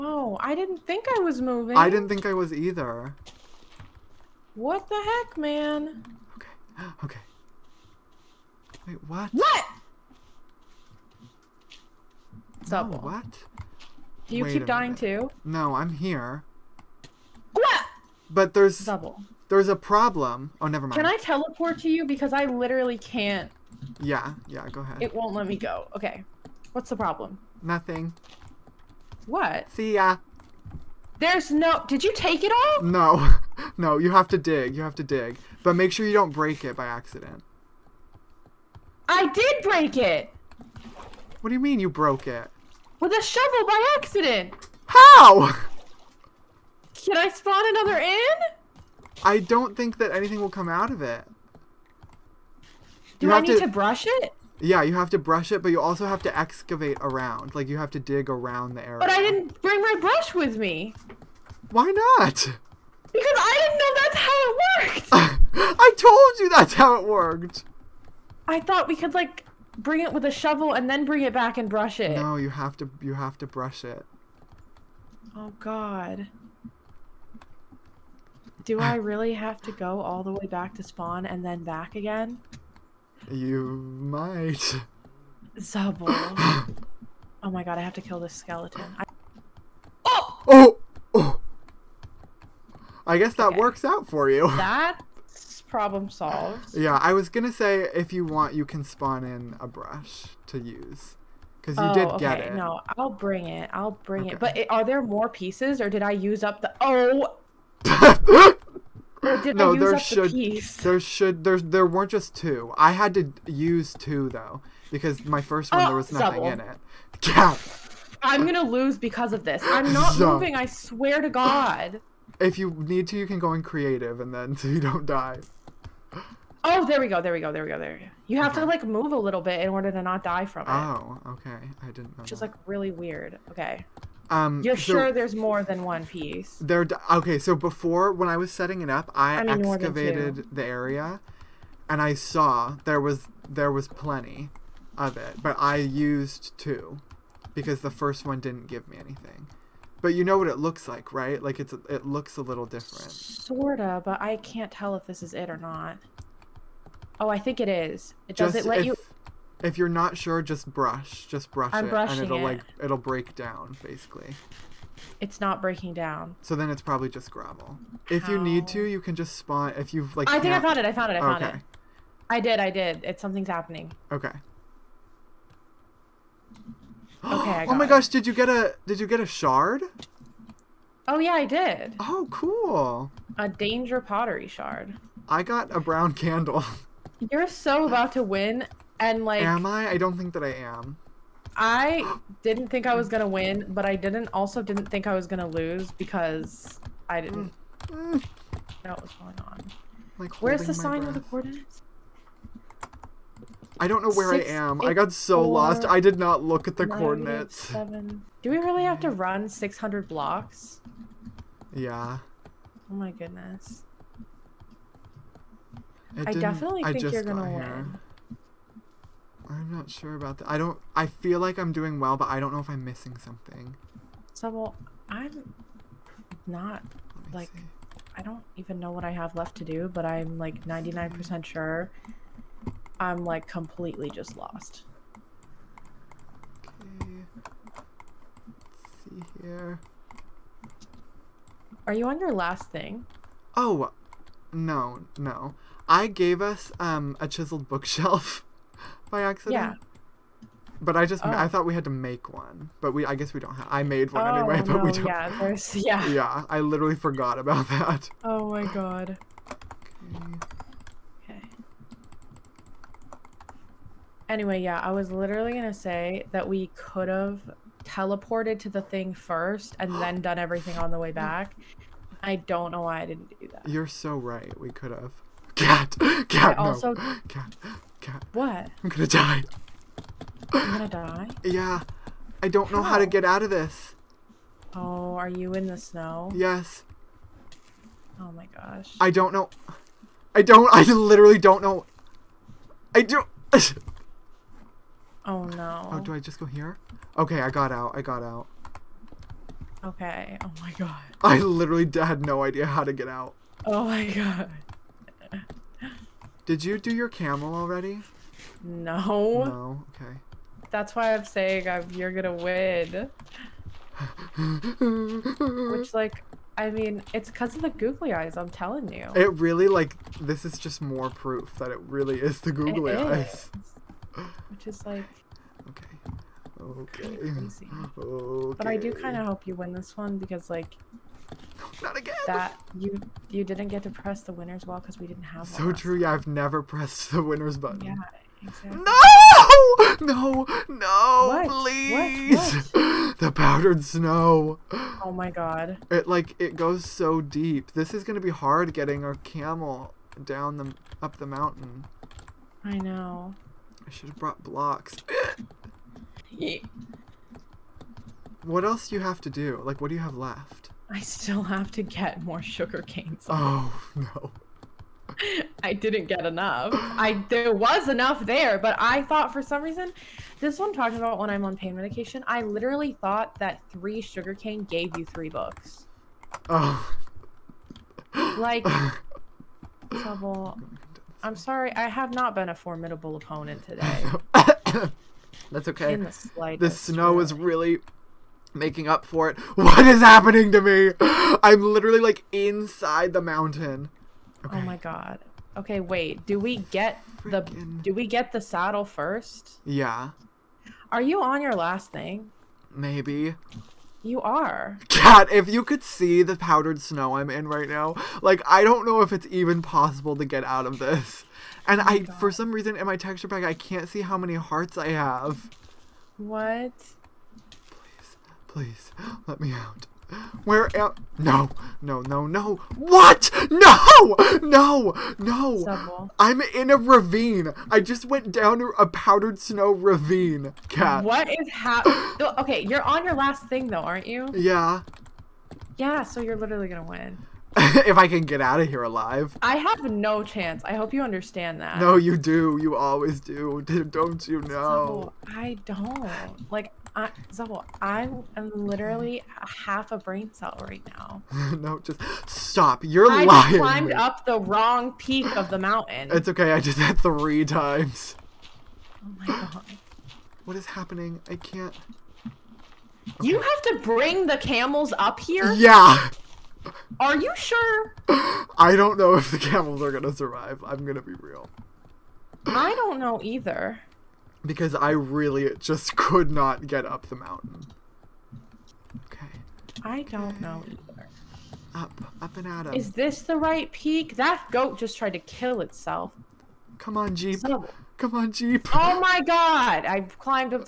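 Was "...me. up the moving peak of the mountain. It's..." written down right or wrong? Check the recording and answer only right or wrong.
wrong.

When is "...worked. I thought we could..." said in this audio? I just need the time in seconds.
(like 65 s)
67 s.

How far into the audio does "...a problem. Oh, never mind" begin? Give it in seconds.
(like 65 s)
19 s.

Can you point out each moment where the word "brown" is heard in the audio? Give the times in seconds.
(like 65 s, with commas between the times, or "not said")
185 s.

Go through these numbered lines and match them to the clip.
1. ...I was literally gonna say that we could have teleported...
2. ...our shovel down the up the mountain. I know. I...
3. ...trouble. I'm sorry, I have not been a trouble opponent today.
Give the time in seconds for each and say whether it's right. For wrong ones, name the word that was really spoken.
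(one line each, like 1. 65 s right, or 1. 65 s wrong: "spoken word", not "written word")
1. 264 s right
2. 349 s wrong: "camel", not "shovel"
3. 379 s wrong: "formidable", not "trouble".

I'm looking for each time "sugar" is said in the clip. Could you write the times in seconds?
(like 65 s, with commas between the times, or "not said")
362 s, 374 s.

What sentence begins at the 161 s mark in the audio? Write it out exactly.
Just brush I'm it, brushing and it'll it.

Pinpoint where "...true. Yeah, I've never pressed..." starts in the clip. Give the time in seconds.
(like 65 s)
335 s.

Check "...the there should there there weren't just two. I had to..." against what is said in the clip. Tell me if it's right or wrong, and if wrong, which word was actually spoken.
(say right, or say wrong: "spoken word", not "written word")
right.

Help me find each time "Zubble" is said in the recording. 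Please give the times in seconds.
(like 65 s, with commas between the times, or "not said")
18 s, 85 s, 425 s.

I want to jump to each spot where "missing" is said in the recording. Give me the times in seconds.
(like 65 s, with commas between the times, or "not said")
222 s.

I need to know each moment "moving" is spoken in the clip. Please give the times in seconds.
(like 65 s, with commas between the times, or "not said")
1 s, 120 s.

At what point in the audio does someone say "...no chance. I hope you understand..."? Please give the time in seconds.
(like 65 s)
439 s.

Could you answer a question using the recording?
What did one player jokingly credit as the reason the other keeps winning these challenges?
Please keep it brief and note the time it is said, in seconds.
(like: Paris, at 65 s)
The googly eyes, at 317 s.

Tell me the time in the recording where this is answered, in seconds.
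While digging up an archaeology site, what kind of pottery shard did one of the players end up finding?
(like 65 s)
183 s.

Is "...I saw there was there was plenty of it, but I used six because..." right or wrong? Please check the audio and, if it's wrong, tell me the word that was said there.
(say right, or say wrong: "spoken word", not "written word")
wrong: "two", not "six".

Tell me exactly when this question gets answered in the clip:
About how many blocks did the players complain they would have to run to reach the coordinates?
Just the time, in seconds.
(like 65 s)
209 s.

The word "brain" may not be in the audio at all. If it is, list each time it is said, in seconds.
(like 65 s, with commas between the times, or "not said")
449 s.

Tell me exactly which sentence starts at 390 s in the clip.
I'm literally like inside the mountain.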